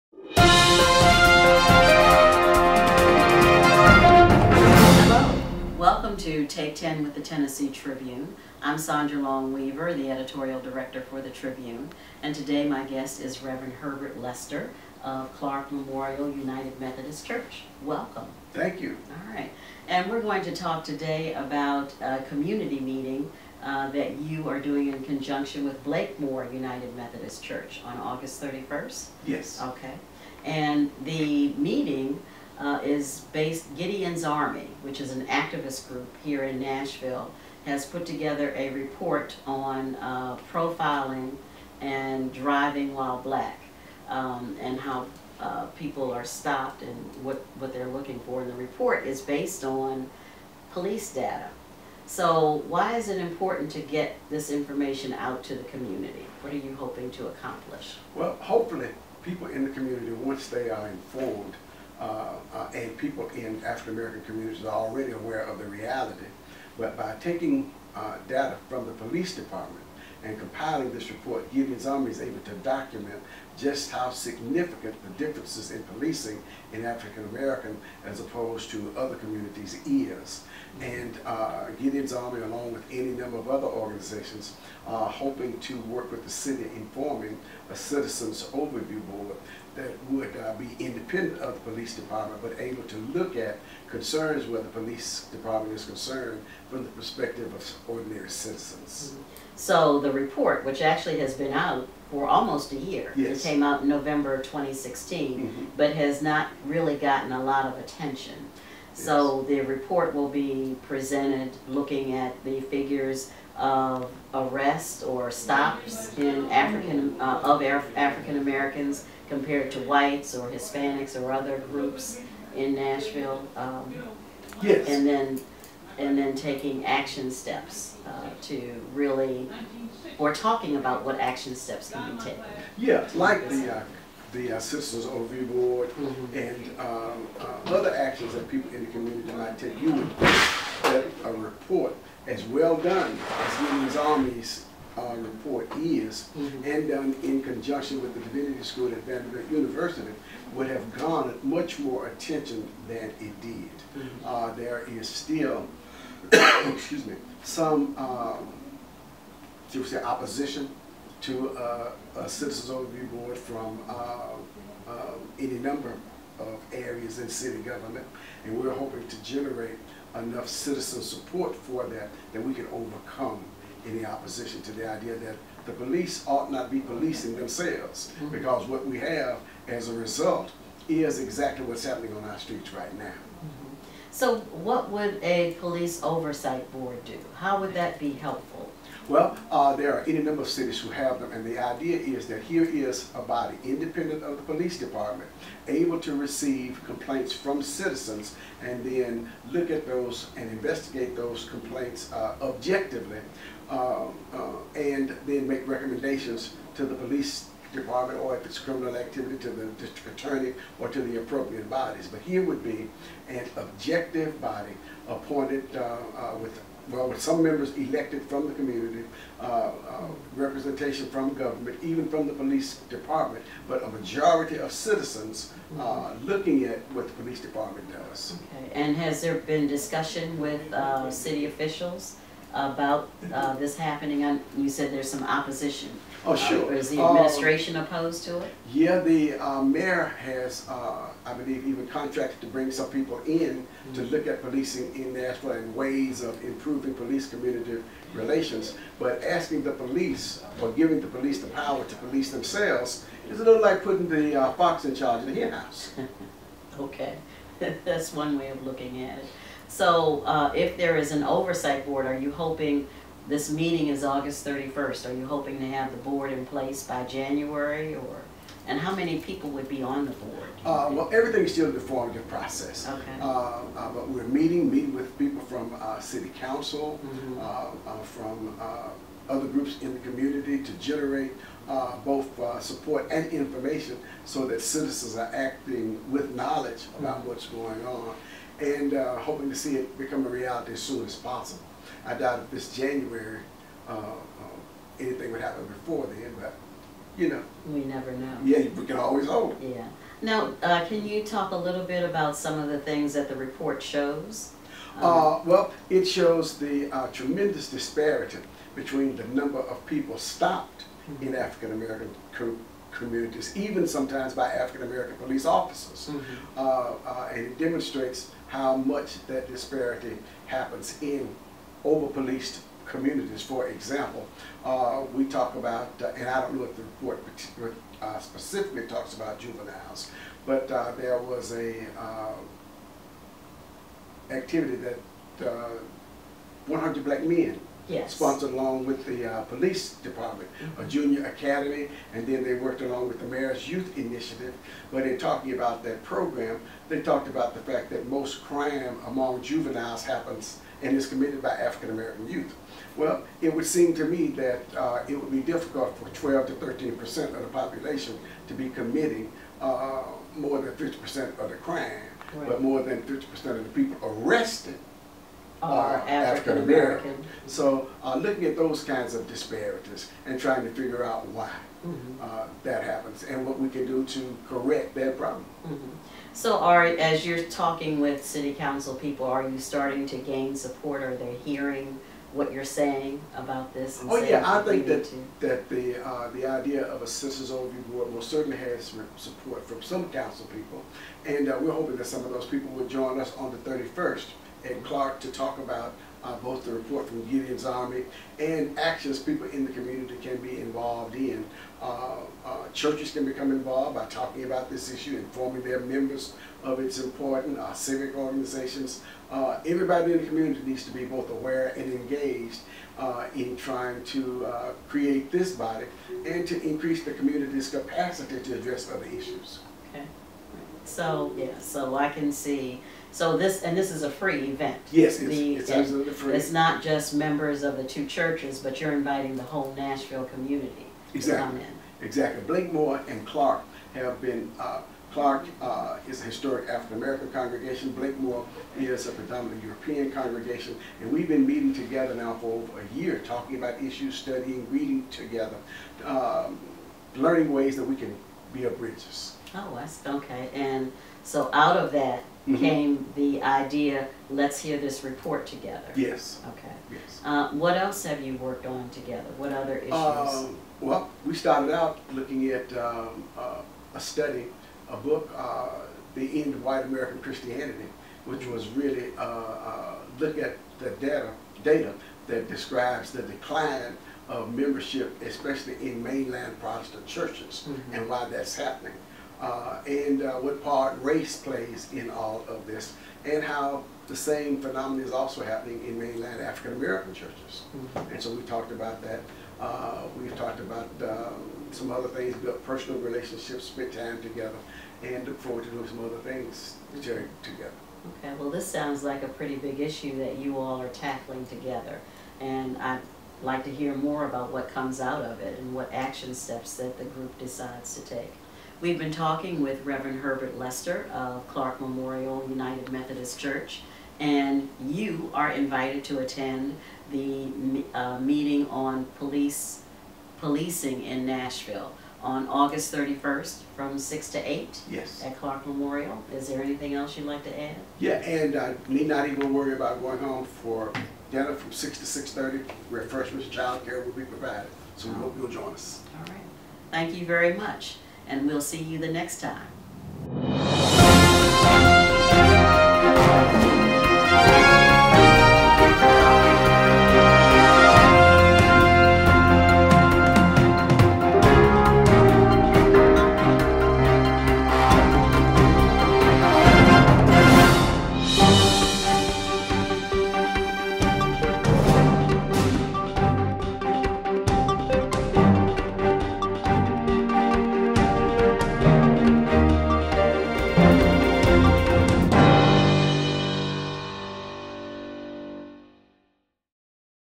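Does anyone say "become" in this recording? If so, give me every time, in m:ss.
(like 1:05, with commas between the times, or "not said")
4:49, 6:43.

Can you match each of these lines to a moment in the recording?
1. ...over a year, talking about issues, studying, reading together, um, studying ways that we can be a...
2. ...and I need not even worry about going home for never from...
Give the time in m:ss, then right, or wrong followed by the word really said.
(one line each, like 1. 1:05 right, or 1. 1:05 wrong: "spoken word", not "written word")
1. 7:22 wrong: "learning", not "studying"
2. 8:48 wrong: "dinner", not "never".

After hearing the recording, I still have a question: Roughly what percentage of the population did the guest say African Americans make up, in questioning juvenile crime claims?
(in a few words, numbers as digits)
12 to 13 percent.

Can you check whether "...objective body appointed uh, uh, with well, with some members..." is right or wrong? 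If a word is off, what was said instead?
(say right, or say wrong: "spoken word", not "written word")
right.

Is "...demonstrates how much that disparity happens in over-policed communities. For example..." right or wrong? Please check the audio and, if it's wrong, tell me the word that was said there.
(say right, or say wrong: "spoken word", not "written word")
right.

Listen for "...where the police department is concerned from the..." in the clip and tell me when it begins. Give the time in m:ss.
1:34.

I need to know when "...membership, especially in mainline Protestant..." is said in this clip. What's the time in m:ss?
7:54.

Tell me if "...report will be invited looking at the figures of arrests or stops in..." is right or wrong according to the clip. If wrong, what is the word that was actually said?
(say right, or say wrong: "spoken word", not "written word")
wrong: "presented", not "invited".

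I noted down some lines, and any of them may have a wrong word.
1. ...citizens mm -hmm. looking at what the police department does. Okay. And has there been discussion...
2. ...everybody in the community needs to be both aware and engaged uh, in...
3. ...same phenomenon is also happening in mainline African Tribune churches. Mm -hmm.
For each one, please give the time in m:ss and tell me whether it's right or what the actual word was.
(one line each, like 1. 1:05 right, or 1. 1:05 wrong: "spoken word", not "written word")
1. 3:44 right
2. 6:49 right
3. 8:04 wrong: "American", not "Tribune".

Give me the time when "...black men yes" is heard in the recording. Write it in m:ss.
5:37.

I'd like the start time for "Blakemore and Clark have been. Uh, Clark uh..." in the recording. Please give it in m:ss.
7:12.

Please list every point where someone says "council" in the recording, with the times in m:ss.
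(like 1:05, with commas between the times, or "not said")
4:36, 6:18, 6:30.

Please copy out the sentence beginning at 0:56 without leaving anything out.
What are you hoping to accomplish?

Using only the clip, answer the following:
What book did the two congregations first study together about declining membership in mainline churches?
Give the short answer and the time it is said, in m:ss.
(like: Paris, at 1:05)
The End of White American Christianity, at 7:46.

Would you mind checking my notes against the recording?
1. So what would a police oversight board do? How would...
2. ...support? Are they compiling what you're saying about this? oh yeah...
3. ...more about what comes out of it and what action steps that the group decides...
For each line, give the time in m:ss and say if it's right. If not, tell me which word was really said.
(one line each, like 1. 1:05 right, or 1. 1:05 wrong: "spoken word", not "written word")
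1. 3:04 right
2. 6:20 wrong: "hearing", not "compiling"
3. 8:24 right.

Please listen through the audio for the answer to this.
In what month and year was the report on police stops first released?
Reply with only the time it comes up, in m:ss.
1:43.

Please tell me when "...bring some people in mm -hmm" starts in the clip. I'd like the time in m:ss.
4:02.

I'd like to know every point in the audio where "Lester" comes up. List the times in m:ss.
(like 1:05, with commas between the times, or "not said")
0:14, 8:30.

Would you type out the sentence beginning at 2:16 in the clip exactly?
and um, uh, other actions that people in the community might take.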